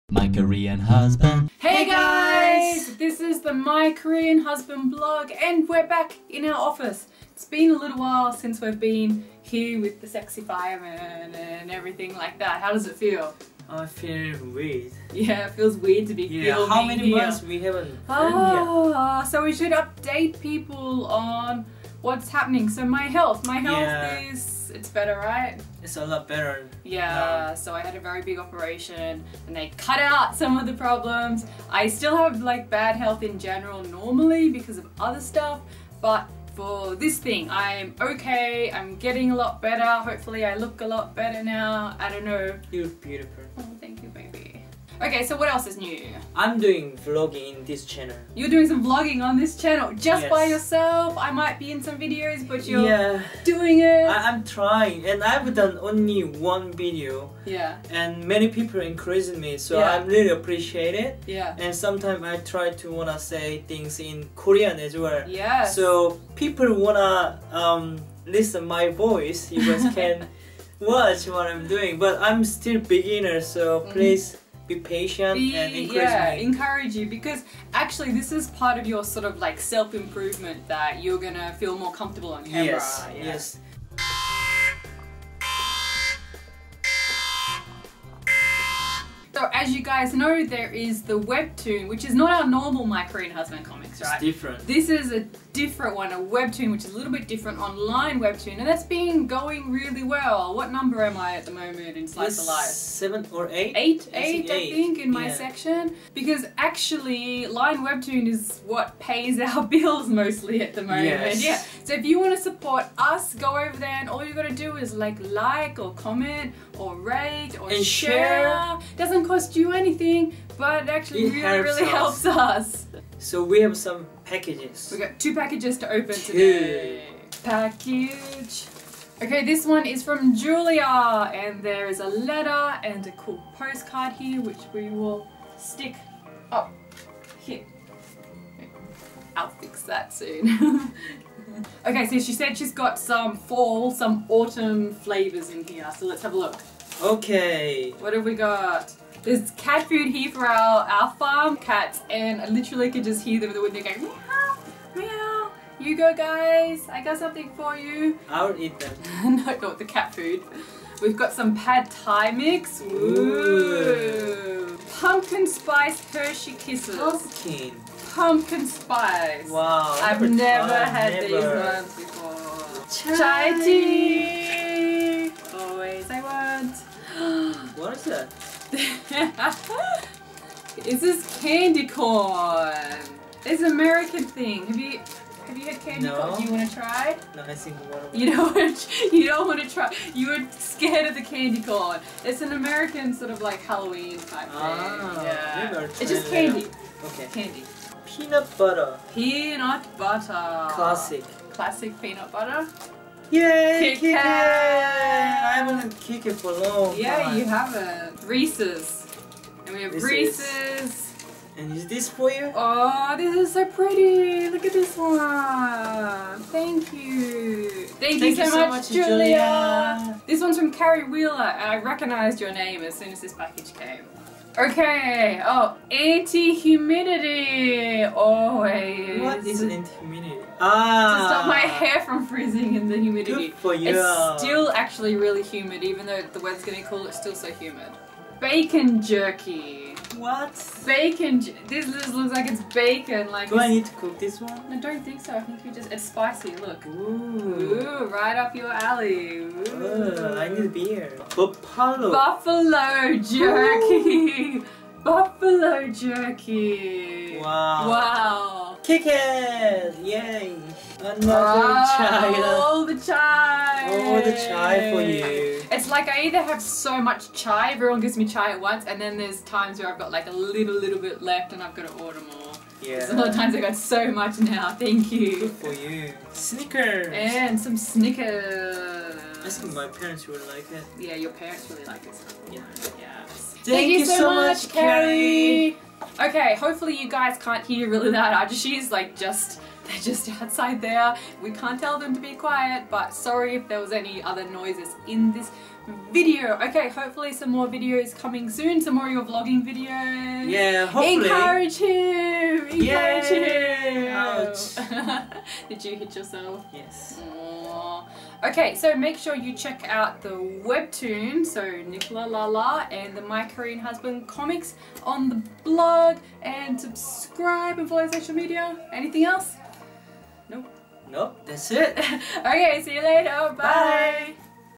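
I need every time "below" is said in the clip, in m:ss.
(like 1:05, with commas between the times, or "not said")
not said.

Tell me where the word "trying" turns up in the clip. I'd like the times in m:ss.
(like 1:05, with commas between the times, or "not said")
0:54.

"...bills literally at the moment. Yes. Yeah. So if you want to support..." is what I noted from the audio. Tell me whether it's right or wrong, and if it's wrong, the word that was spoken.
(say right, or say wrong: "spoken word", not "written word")
wrong: "mostly", not "literally".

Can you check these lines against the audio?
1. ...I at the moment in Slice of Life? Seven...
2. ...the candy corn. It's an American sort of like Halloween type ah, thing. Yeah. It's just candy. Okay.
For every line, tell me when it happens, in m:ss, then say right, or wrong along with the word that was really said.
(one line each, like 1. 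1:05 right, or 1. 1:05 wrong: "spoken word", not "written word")
1. 1:41 right
2. 3:11 right.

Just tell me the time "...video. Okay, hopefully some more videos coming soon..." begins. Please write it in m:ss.
4:56.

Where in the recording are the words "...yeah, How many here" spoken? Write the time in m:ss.
0:16.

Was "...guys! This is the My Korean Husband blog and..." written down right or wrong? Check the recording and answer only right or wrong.
right.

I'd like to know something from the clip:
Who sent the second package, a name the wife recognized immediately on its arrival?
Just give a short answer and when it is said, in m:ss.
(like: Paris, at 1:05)
Carrie Wheeler, at 3:40.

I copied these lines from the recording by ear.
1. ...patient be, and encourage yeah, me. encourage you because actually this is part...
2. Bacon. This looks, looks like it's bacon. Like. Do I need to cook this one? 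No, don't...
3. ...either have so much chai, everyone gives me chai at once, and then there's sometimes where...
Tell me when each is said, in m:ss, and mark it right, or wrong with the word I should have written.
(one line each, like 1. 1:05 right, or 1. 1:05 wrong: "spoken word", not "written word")
1. 1:14 right
2. 4:00 right
3. 4:26 wrong: "times", not "sometimes".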